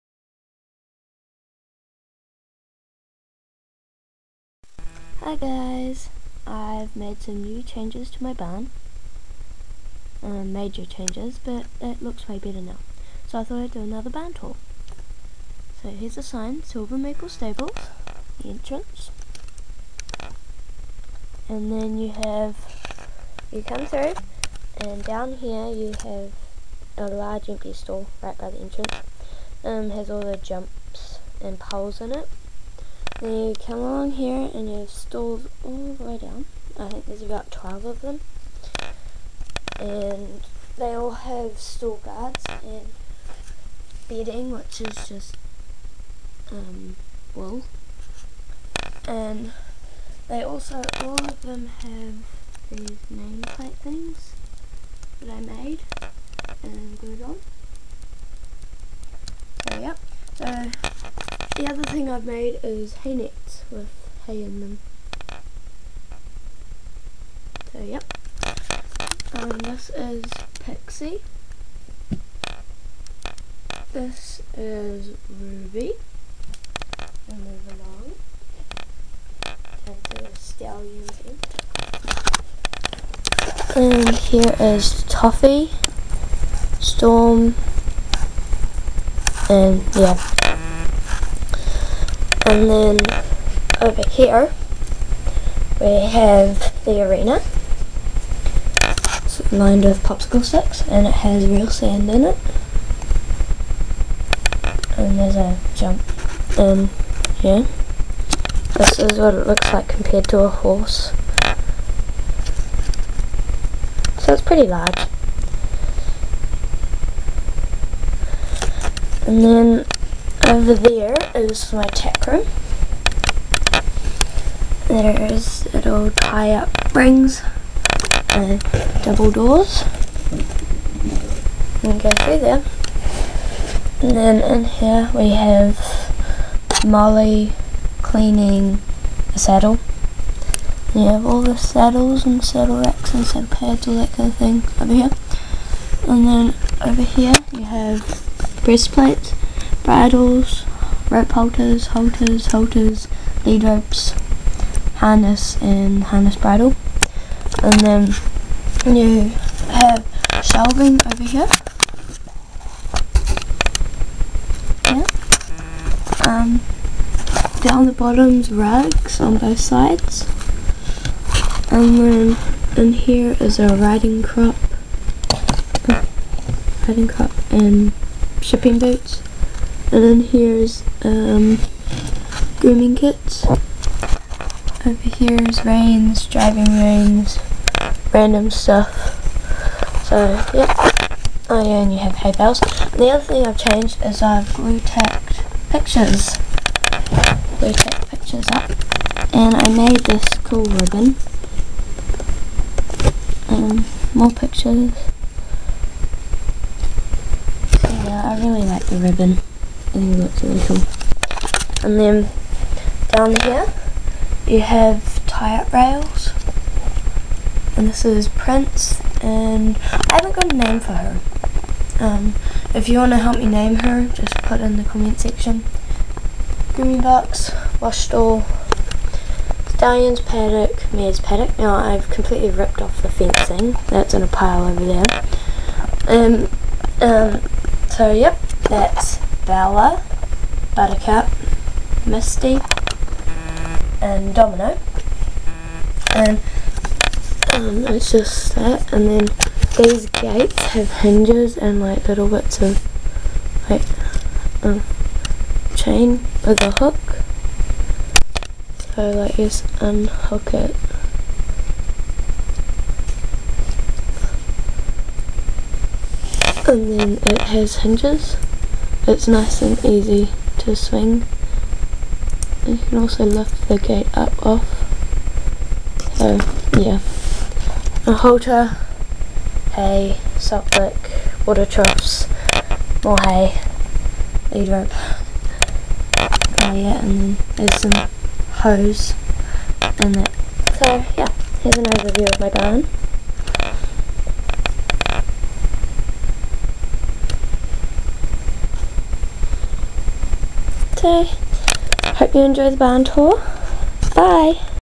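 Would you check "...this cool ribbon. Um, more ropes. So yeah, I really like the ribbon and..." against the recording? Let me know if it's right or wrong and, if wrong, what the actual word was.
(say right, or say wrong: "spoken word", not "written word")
wrong: "pictures", not "ropes".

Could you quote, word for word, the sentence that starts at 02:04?
There's little tie up rings, and double doors.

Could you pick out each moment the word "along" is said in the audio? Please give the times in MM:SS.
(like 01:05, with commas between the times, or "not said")
00:33, 01:17.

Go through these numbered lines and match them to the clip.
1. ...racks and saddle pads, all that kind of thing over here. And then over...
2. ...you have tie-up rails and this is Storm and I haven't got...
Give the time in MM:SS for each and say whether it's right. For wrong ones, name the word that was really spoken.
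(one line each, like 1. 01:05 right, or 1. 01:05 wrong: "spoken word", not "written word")
1. 02:22 right
2. 03:34 wrong: "Prince", not "Storm".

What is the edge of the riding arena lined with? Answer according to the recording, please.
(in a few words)
Popsicle sticks.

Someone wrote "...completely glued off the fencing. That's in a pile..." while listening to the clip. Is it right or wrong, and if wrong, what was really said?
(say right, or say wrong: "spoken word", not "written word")
wrong: "ripped", not "glued".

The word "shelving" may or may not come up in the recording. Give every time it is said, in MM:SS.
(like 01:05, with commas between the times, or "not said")
02:40.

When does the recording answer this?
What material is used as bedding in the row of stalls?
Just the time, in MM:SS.
00:47.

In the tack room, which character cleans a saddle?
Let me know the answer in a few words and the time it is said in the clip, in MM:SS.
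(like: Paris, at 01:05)
Molly, at 02:16.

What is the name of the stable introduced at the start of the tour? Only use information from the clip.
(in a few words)
Silver Maple Stables.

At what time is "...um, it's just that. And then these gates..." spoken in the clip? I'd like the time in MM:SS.
04:07.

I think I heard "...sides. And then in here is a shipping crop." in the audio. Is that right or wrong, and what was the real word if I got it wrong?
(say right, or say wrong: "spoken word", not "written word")
wrong: "riding", not "shipping".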